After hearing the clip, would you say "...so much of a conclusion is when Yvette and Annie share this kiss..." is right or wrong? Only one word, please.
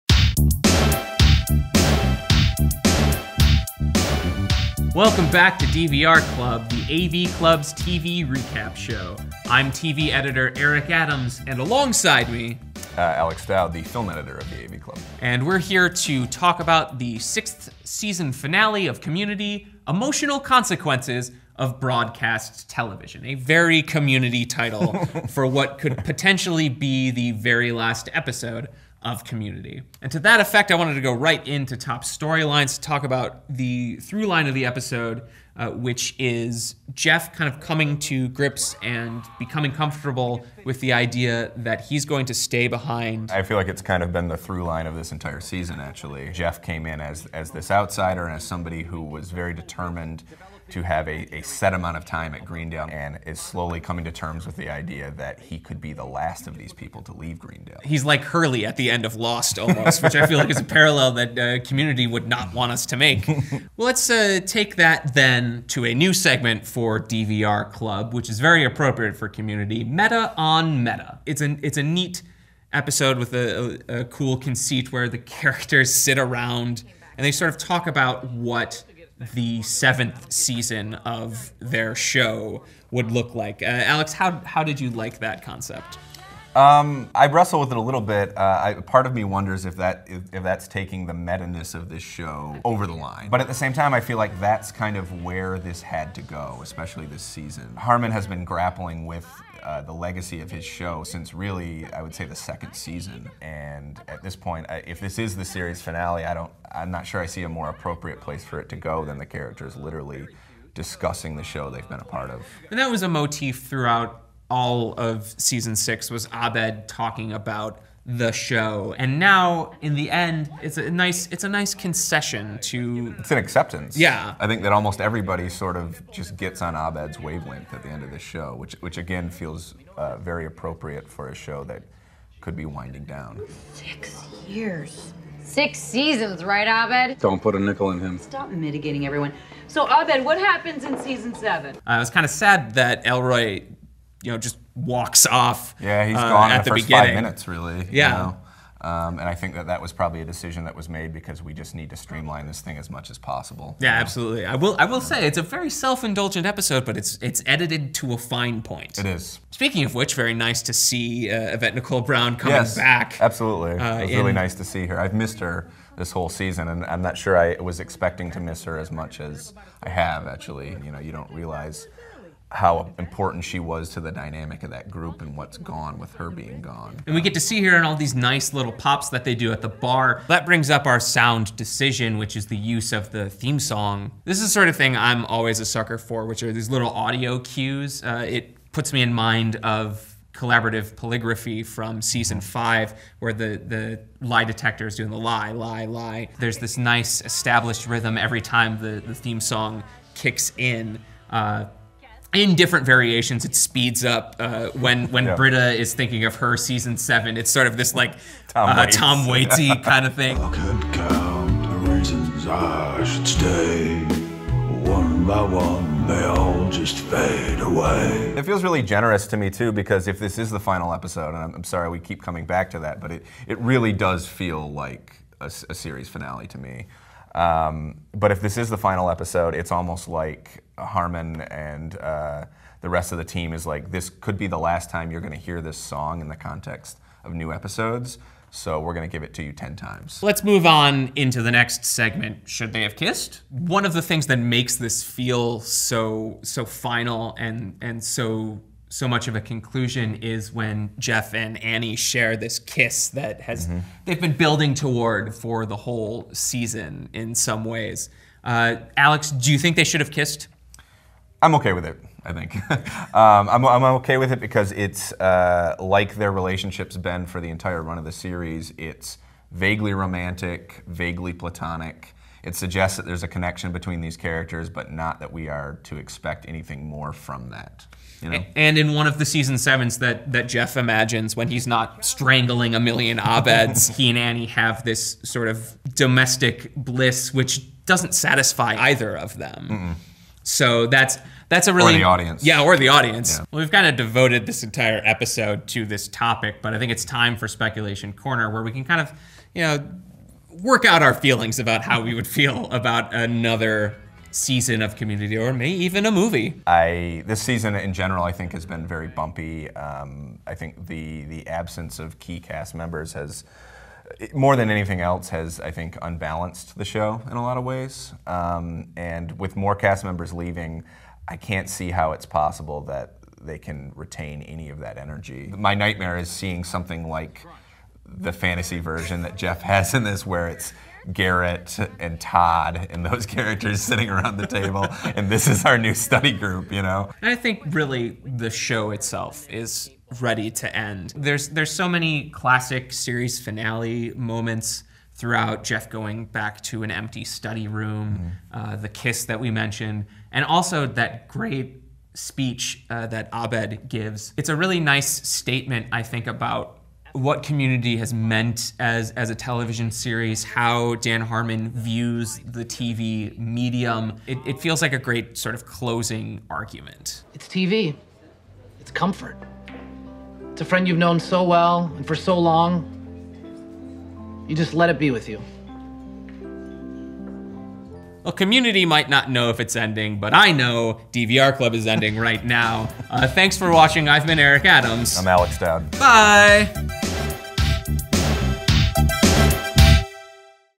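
wrong.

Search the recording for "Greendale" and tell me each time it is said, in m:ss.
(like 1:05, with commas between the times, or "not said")
0:52, 0:57.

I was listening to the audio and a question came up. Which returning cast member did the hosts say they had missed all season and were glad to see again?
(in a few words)
Yvette Nicole Brown.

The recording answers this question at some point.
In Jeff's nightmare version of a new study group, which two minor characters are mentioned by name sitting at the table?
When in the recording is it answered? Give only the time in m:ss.
5:31.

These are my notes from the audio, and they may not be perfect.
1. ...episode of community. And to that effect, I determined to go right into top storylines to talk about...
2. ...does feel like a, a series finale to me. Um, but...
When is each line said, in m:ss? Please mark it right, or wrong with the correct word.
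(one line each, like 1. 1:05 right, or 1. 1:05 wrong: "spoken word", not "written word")
1. 0:28 wrong: "wanted", not "determined"
2. 3:43 right.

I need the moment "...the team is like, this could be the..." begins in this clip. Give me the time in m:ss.
3:53.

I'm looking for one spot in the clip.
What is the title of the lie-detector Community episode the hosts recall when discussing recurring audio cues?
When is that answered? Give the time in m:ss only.
3:10.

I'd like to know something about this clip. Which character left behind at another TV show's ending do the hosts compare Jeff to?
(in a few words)
Hurley.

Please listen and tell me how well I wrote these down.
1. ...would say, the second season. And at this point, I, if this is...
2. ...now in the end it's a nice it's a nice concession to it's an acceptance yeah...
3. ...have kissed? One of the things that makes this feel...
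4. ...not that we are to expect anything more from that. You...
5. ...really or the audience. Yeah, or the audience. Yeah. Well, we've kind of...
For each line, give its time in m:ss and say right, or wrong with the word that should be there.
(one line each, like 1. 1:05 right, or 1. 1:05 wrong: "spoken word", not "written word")
1. 1:42 right
2. 1:59 right
3. 4:02 right
4. 4:34 right
5. 4:51 right.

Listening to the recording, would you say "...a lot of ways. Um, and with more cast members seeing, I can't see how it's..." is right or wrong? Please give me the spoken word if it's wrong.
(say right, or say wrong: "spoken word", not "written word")
wrong: "leaving", not "seeing".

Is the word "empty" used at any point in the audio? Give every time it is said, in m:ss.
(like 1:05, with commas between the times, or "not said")
5:46.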